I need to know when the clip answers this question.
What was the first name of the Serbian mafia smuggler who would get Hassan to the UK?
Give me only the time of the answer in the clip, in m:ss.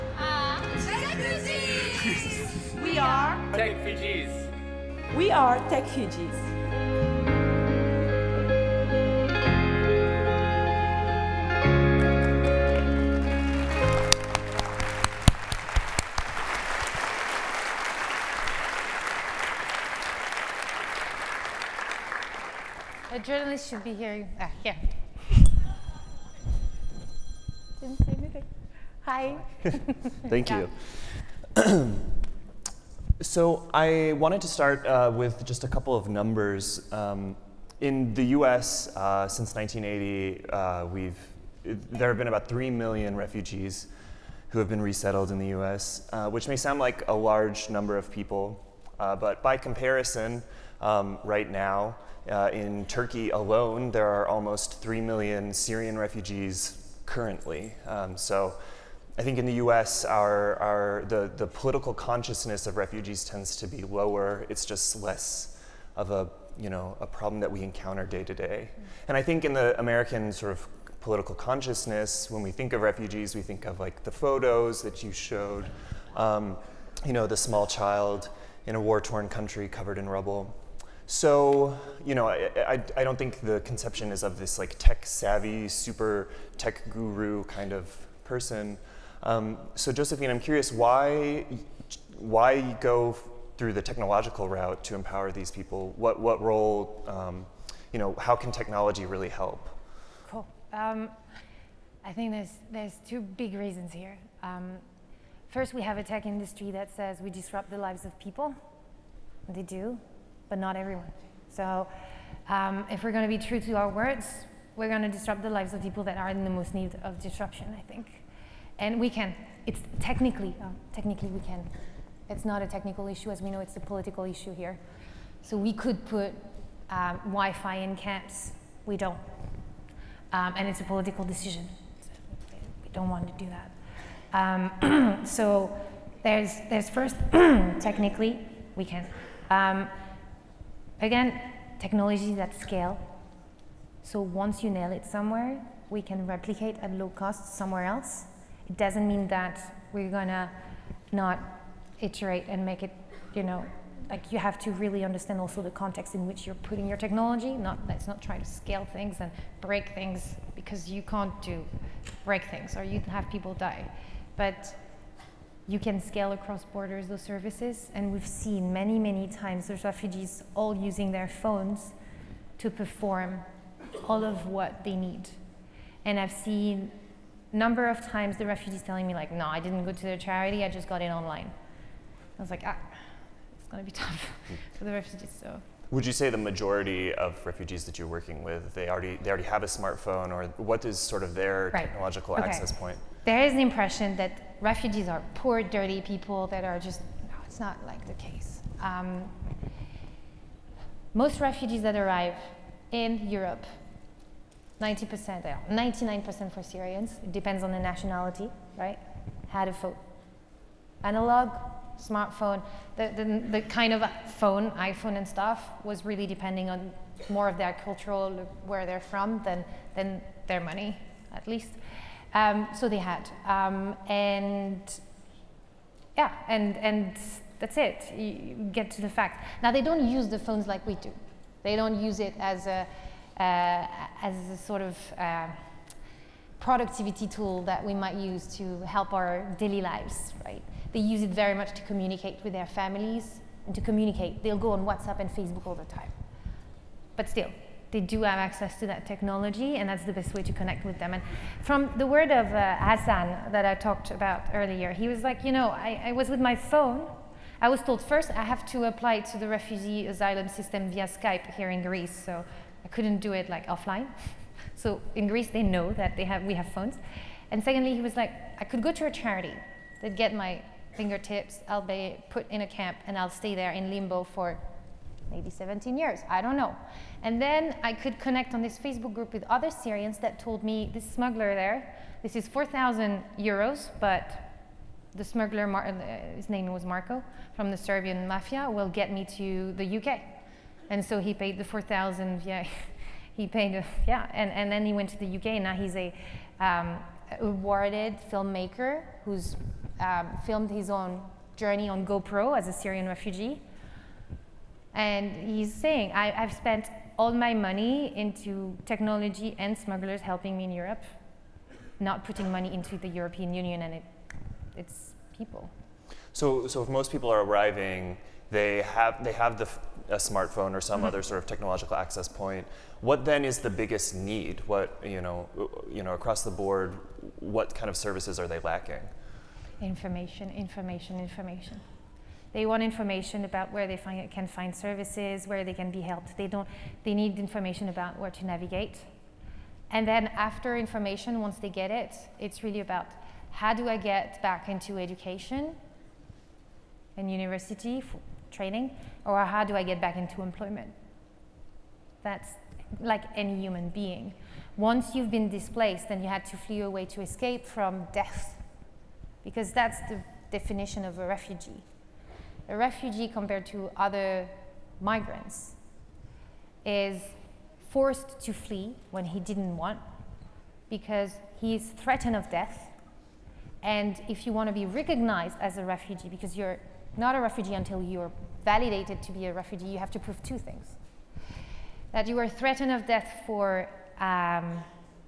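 4:46.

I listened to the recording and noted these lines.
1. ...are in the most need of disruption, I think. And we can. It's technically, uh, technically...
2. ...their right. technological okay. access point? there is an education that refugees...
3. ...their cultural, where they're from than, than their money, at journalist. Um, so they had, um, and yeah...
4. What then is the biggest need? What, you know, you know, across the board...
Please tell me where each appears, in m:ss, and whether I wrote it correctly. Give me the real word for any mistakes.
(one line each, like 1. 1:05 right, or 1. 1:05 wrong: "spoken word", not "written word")
1. 1:56 right
2. 3:11 wrong: "impression", not "education"
3. 3:37 wrong: "least", not "journalist"
4. 5:23 right.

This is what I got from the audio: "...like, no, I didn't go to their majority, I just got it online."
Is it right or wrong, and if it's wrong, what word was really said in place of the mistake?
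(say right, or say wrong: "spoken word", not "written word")
wrong: "charity", not "majority".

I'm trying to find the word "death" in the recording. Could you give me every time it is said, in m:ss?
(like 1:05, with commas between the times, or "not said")
5:58, 6:12, 6:23.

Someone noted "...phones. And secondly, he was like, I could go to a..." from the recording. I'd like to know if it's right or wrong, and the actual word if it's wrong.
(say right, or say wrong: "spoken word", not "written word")
right.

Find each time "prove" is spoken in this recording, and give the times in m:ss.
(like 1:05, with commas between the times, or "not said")
6:20.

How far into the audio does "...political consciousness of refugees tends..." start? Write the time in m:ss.
1:01.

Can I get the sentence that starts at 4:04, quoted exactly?
They'll go on WhatsApp and Facebook all the time.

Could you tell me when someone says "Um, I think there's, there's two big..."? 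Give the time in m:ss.
1:40.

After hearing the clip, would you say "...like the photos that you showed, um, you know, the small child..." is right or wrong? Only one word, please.
right.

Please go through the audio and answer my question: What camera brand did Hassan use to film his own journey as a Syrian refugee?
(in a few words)
GoPro.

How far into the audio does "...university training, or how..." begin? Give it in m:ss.
5:47.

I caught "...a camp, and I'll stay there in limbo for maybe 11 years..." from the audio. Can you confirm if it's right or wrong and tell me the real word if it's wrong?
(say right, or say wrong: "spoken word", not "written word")
wrong: "17", not "11".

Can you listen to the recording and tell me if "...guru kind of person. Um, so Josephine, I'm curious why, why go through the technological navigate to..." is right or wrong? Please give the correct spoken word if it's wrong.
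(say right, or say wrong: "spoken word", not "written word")
wrong: "route", not "navigate".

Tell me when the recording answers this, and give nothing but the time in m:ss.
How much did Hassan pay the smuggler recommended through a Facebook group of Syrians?
4:42.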